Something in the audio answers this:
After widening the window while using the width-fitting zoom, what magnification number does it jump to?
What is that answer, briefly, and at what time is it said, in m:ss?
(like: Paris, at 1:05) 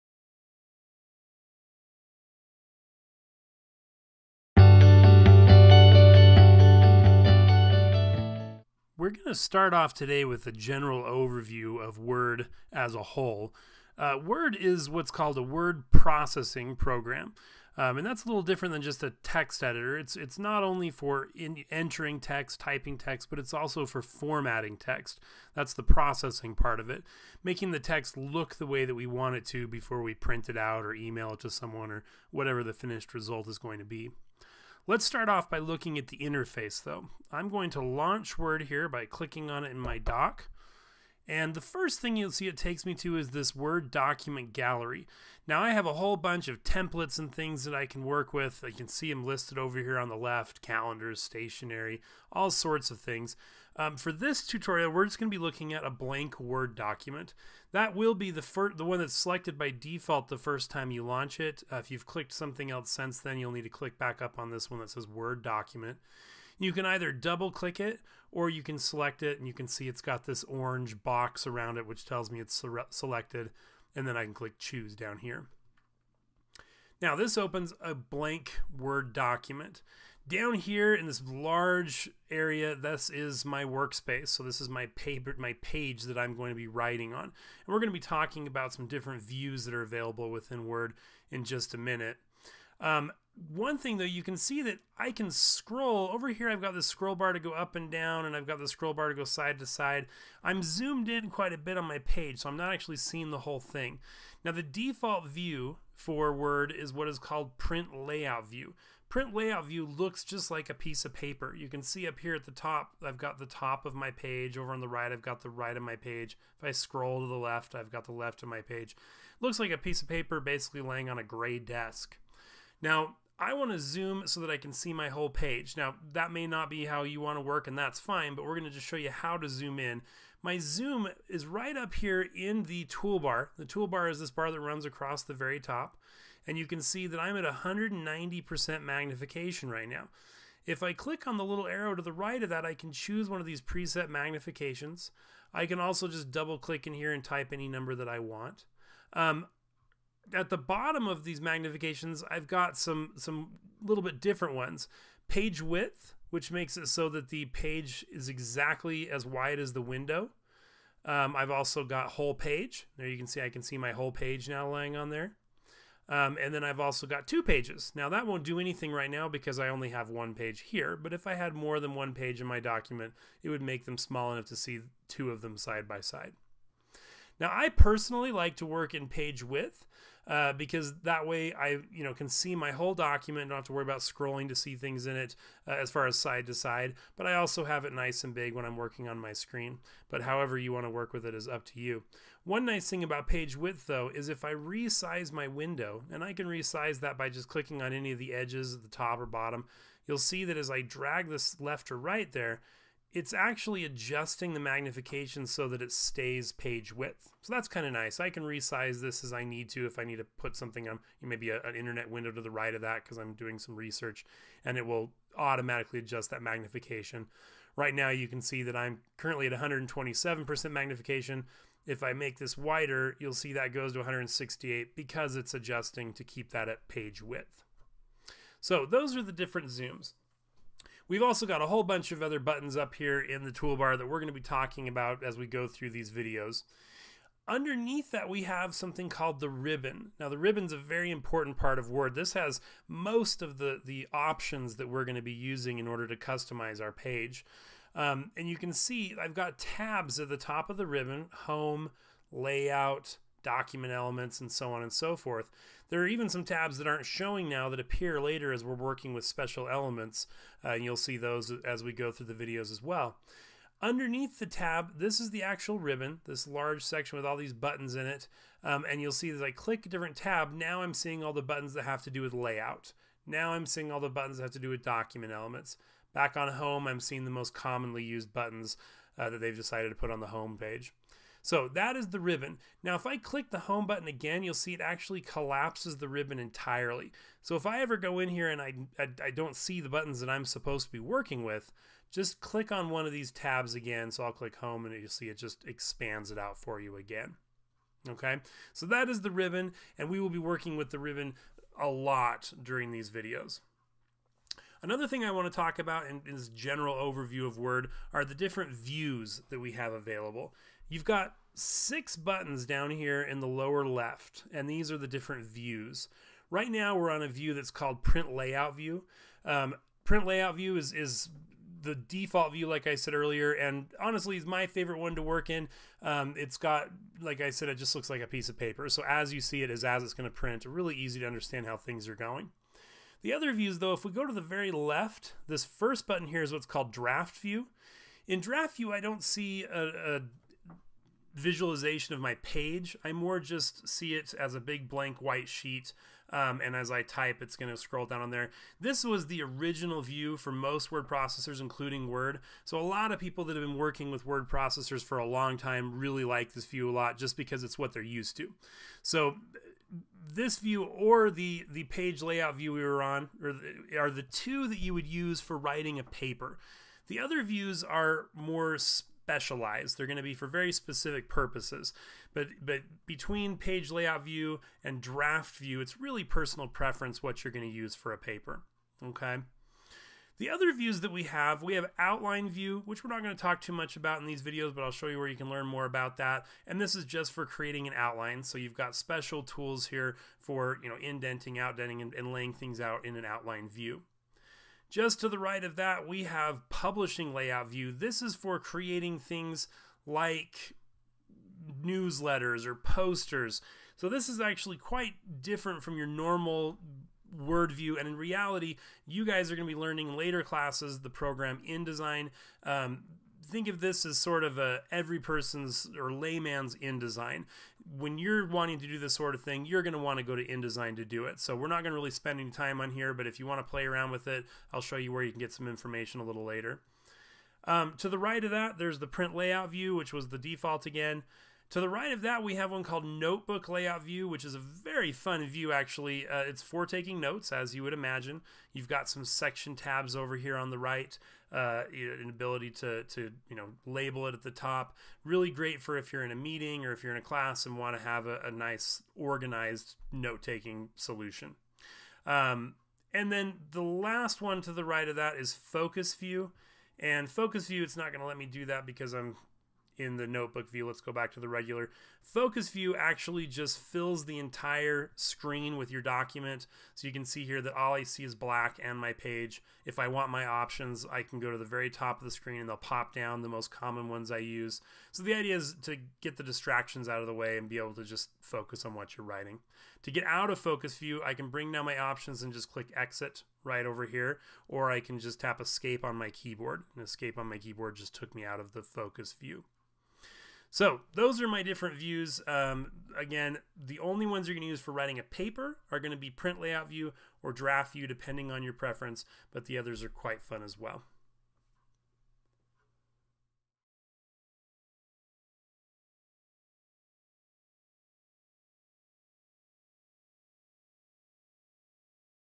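168, at 3:43.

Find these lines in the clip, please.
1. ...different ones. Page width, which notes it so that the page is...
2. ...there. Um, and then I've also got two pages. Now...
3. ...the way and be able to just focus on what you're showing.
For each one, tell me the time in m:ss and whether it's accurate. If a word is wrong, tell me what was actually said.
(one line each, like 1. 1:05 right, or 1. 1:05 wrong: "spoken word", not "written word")
1. 2:34 wrong: "makes", not "notes"
2. 2:45 right
3. 7:57 wrong: "writing", not "showing".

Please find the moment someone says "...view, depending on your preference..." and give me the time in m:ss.
8:17.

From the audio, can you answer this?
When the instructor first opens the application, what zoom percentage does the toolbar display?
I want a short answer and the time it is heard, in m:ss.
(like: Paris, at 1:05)
190%, at 2:17.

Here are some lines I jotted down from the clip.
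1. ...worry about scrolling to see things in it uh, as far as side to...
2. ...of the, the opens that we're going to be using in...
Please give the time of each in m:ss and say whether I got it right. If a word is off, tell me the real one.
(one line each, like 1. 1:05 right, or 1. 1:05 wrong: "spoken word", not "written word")
1. 3:03 right
2. 4:03 wrong: "options", not "opens".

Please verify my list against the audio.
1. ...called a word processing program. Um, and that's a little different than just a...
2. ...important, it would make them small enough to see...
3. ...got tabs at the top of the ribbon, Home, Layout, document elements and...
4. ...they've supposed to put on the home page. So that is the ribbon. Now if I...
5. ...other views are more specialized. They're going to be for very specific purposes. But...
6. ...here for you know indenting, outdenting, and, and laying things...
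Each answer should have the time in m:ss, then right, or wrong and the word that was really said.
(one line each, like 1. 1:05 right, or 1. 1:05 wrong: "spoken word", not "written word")
1. 0:15 right
2. 2:52 wrong: "document", not "important"
3. 4:09 right
4. 4:39 wrong: "decided", not "supposed"
5. 6:07 right
6. 6:29 right.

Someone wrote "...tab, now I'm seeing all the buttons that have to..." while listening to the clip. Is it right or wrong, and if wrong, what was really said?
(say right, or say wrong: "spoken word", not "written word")
right.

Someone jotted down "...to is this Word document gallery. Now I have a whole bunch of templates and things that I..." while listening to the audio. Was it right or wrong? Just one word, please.
right.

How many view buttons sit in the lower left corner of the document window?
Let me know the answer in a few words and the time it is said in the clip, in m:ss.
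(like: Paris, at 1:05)
6, at 5:11.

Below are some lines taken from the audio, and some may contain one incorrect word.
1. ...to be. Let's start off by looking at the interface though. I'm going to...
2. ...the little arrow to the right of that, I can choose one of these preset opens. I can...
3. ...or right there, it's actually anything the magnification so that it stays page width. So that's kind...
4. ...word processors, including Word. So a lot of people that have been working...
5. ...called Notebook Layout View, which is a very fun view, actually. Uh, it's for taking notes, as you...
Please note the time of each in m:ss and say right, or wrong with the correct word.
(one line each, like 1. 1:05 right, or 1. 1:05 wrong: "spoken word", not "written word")
1. 0:33 right
2. 2:21 wrong: "magnifications", not "opens"
3. 3:21 wrong: "adjusting", not "anything"
4. 5:50 right
5. 7:12 right.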